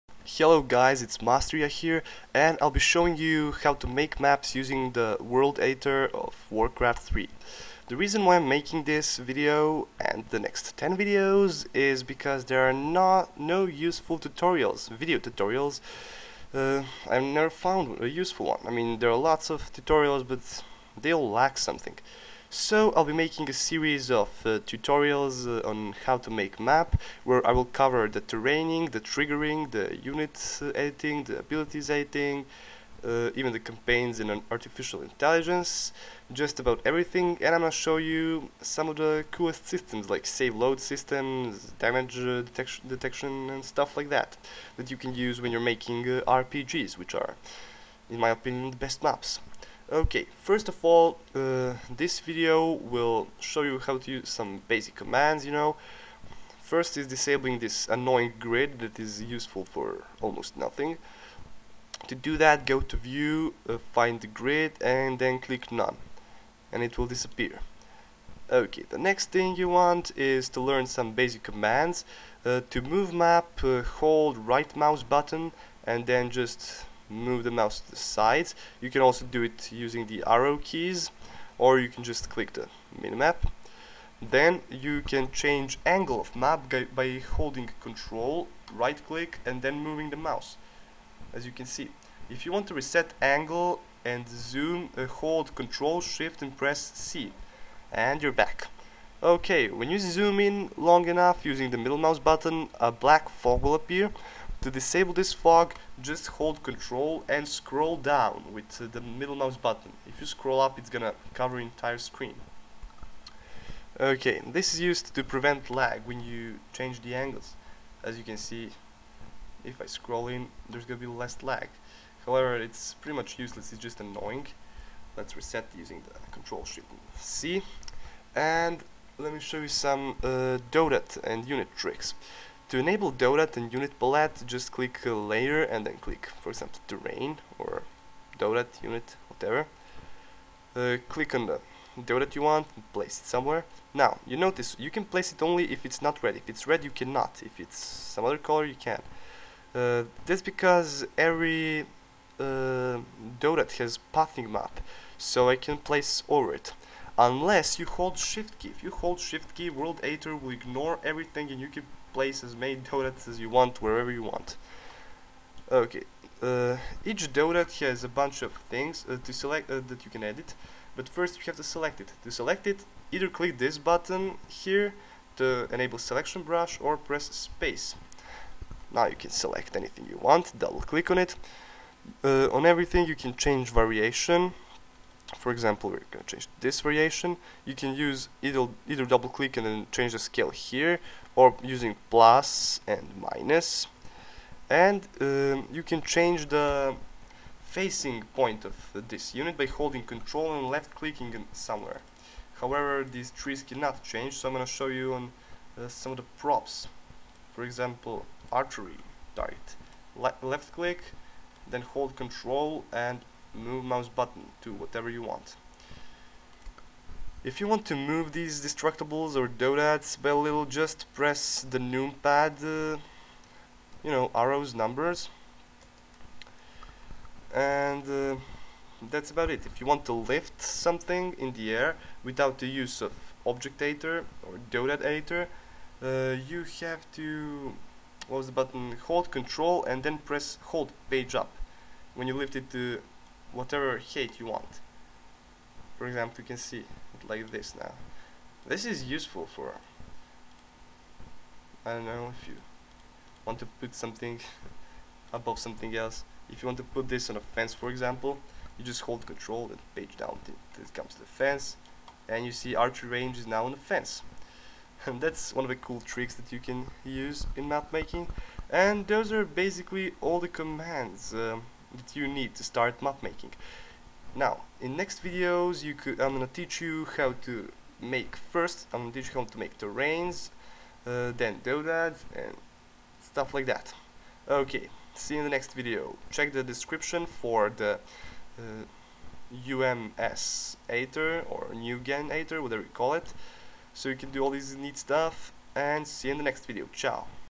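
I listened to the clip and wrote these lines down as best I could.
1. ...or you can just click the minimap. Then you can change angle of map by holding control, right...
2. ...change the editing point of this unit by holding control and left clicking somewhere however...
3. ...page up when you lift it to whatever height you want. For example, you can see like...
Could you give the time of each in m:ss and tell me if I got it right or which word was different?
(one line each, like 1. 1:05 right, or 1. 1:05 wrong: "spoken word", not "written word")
1. 1:21 right
2. 3:16 wrong: "facing", not "editing"
3. 4:01 right.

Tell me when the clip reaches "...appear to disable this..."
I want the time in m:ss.
1:43.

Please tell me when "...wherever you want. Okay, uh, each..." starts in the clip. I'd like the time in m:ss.
2:43.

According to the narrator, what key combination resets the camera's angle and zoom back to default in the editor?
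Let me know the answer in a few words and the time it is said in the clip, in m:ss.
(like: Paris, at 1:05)
Control Shift C, at 1:35.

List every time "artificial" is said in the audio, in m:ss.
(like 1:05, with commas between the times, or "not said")
0:34.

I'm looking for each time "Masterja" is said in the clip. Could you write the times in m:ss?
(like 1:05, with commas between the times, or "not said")
0:01.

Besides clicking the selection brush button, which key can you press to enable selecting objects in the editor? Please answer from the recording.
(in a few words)
Space.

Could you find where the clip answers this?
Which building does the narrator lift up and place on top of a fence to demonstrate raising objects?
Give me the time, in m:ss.
4:22.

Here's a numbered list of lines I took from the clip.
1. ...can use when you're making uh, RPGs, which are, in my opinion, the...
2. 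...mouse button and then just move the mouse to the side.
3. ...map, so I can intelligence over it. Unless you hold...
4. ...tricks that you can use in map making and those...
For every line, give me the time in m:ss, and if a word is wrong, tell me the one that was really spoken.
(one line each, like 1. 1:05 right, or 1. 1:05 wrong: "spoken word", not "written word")
1. 0:44 right
2. 1:14 right
3. 2:34 wrong: "place", not "intelligence"
4. 4:26 right.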